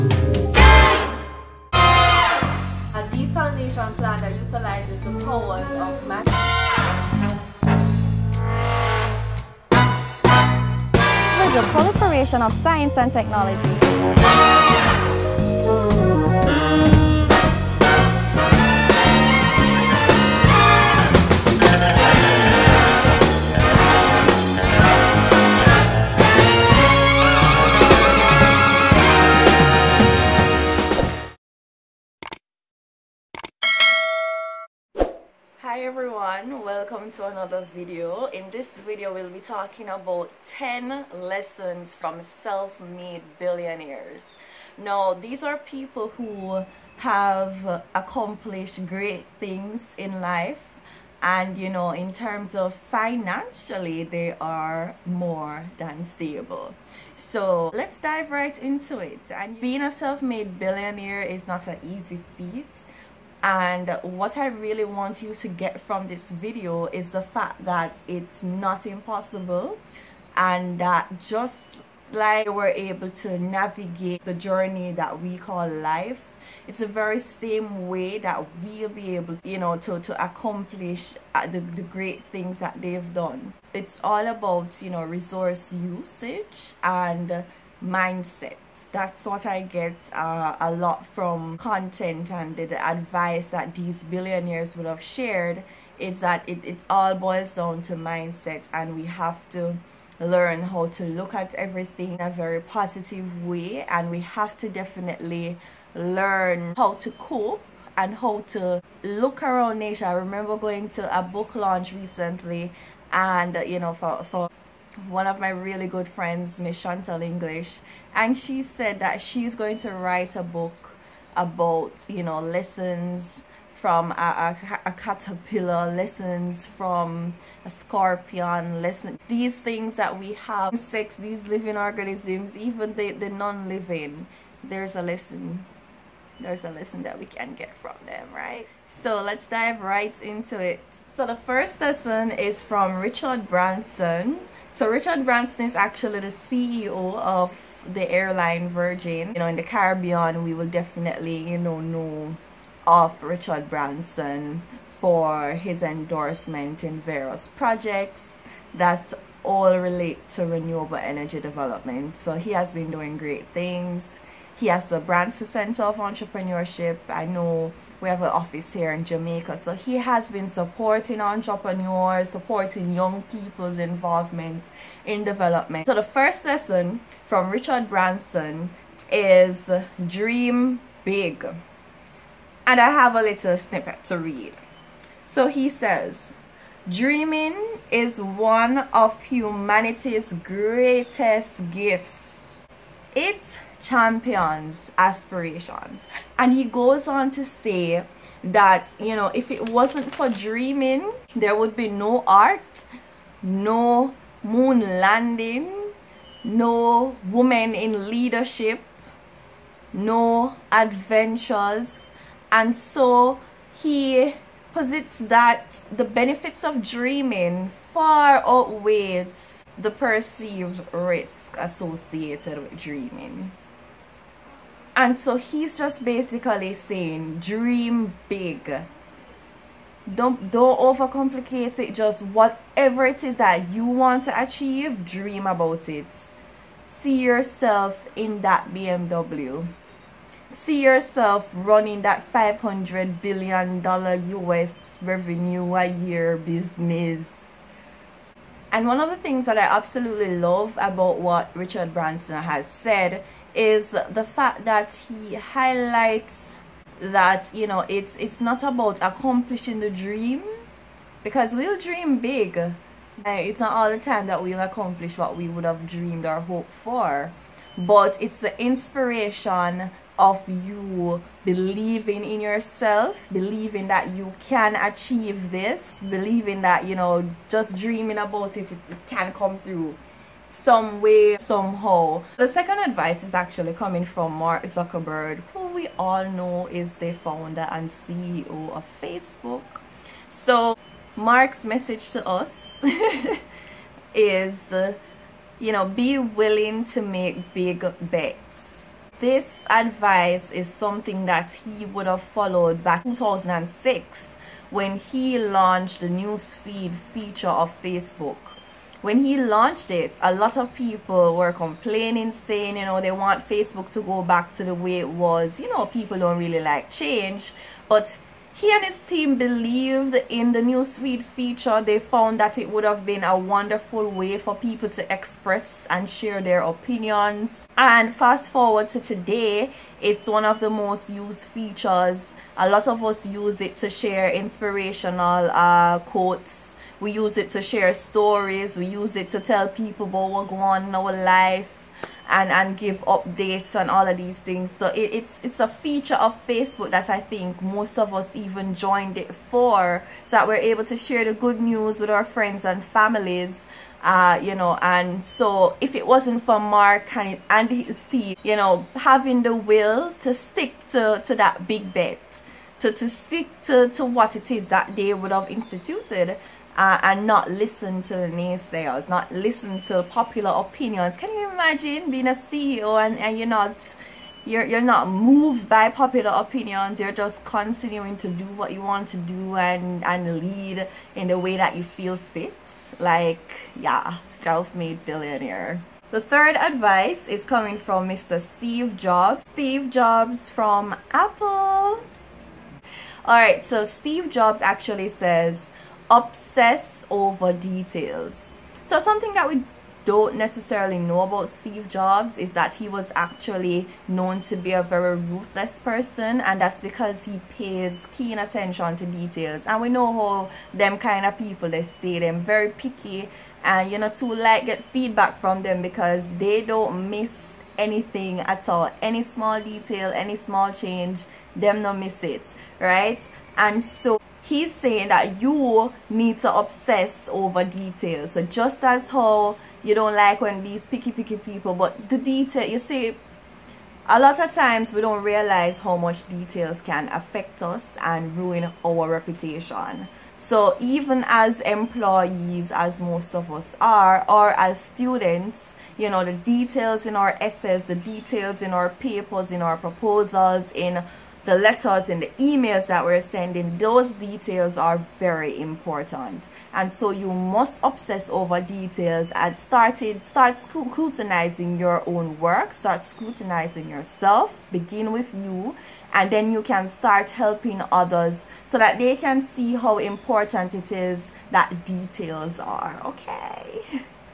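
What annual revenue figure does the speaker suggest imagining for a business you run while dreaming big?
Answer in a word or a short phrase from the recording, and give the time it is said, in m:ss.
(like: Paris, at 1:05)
500 billion dollars, at 4:02.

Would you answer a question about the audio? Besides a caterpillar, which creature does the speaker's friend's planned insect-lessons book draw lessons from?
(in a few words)
Scorpion.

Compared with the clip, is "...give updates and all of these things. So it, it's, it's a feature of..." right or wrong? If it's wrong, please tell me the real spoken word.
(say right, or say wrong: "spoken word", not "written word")
right.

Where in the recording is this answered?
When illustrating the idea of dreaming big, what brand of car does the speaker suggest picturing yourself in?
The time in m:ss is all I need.
3:58.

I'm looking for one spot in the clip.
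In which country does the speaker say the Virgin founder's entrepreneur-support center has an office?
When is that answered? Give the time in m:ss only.
2:49.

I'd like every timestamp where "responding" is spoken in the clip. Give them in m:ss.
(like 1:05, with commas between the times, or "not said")
not said.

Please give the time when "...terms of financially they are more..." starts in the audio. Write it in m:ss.
0:52.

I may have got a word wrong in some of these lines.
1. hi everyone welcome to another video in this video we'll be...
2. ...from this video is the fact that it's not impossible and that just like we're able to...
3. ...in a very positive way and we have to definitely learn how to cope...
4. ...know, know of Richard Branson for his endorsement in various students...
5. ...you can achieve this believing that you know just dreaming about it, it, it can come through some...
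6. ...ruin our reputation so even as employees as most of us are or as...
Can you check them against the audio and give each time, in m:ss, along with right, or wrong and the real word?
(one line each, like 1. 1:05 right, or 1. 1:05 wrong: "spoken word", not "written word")
1. 0:35 right
2. 1:05 right
3. 1:42 right
4. 2:31 wrong: "projects", not "students"
5. 4:34 right
6. 7:18 right.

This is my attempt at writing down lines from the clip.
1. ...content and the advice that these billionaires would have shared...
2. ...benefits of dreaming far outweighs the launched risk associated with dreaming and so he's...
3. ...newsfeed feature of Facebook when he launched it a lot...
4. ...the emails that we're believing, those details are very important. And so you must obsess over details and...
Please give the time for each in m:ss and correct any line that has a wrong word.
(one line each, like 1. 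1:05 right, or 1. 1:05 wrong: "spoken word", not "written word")
1. 1:31 right
2. 3:36 wrong: "perceived", not "launched"
3. 5:06 right
4. 7:32 wrong: "sending", not "believing".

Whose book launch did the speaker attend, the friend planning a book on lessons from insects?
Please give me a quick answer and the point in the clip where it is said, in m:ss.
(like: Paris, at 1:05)
Chantal English, at 1:56.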